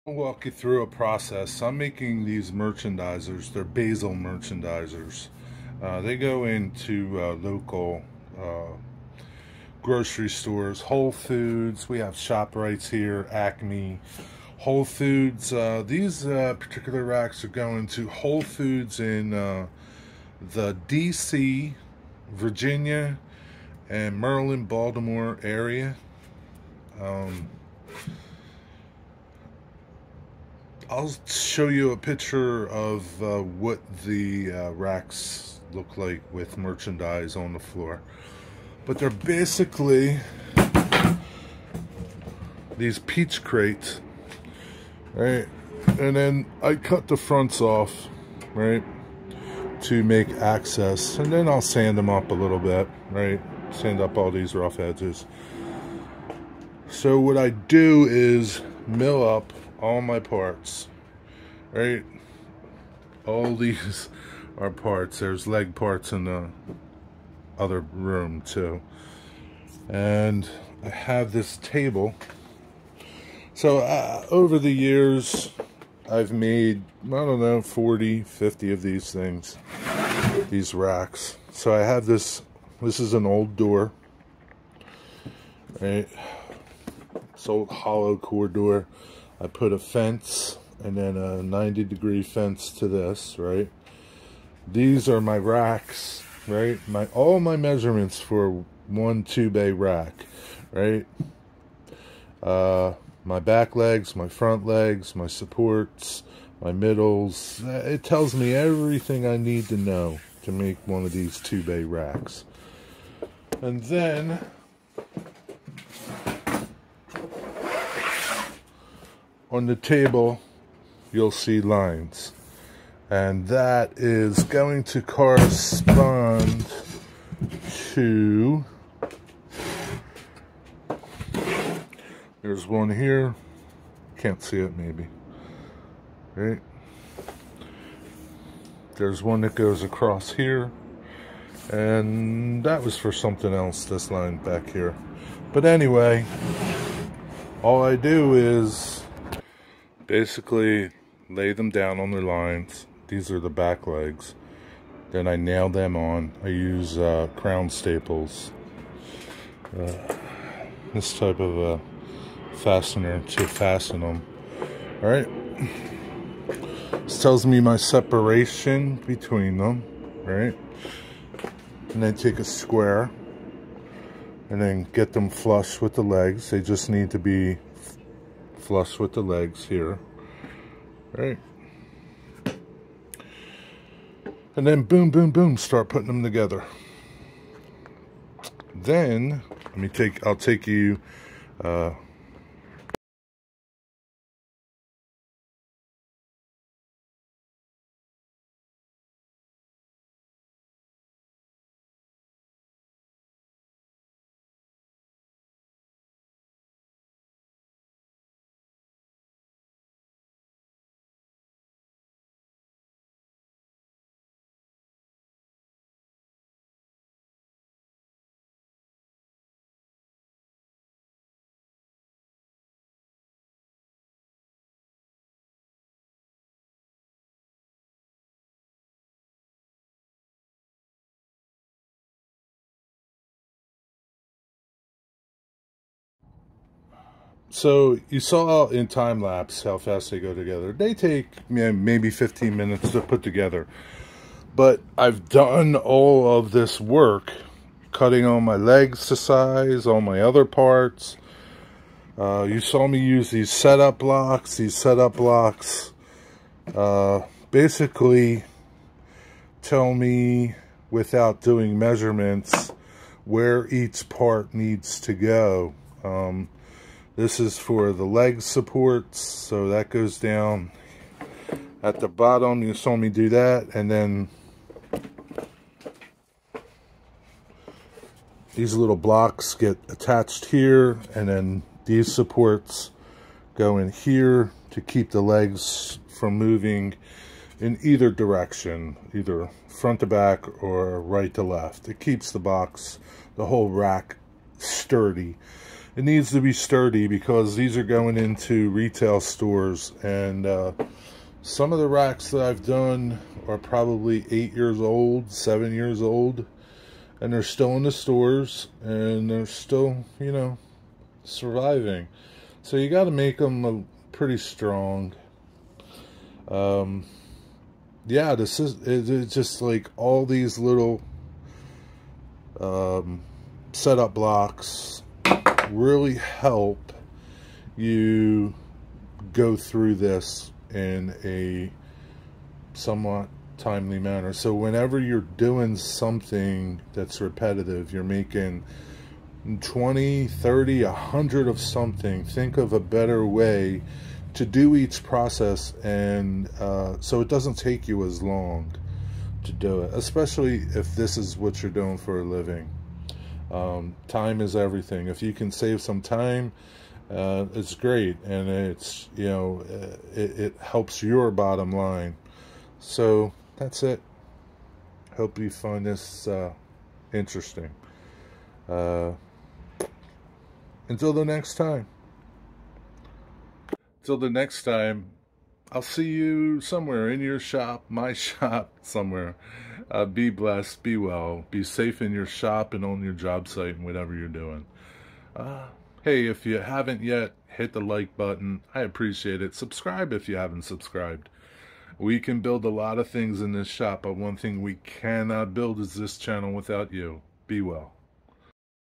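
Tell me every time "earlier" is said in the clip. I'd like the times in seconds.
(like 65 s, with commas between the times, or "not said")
not said.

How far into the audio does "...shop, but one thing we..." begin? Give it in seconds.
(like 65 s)
393 s.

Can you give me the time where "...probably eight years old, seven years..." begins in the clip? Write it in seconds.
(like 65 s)
303 s.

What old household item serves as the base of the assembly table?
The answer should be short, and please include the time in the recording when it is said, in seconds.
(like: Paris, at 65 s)
Hollow core door, at 87 s.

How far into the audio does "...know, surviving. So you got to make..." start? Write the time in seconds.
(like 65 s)
310 s.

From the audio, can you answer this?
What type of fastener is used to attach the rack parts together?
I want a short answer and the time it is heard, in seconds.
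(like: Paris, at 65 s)
Crown staples, at 157 s.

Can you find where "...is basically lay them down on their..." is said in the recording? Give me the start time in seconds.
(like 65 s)
148 s.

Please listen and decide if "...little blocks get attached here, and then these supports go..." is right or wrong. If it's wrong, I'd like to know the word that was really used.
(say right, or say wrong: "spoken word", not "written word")
right.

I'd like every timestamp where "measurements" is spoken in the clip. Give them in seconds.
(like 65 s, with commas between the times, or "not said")
97 s, 261 s.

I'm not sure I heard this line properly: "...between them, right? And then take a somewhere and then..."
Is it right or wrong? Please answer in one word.
wrong.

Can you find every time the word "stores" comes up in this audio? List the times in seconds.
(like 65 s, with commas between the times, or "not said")
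10 s, 299 s, 307 s.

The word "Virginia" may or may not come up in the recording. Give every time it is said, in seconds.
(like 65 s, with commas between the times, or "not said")
22 s.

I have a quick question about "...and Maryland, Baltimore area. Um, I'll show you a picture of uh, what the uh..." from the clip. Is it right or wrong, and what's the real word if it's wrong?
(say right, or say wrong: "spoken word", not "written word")
right.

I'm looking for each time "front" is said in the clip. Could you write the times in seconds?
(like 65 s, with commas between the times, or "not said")
47 s, 104 s, 289 s.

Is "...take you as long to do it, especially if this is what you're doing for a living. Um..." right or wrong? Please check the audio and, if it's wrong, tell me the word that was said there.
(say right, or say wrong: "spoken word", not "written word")
right.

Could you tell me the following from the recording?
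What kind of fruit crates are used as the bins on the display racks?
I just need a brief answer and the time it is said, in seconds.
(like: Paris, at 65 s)
Peach crates, at 42 s.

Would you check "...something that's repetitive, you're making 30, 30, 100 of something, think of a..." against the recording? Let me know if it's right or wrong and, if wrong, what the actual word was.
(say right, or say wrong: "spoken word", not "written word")
wrong: "20", not "30".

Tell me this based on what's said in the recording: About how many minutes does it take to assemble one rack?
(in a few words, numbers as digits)
15.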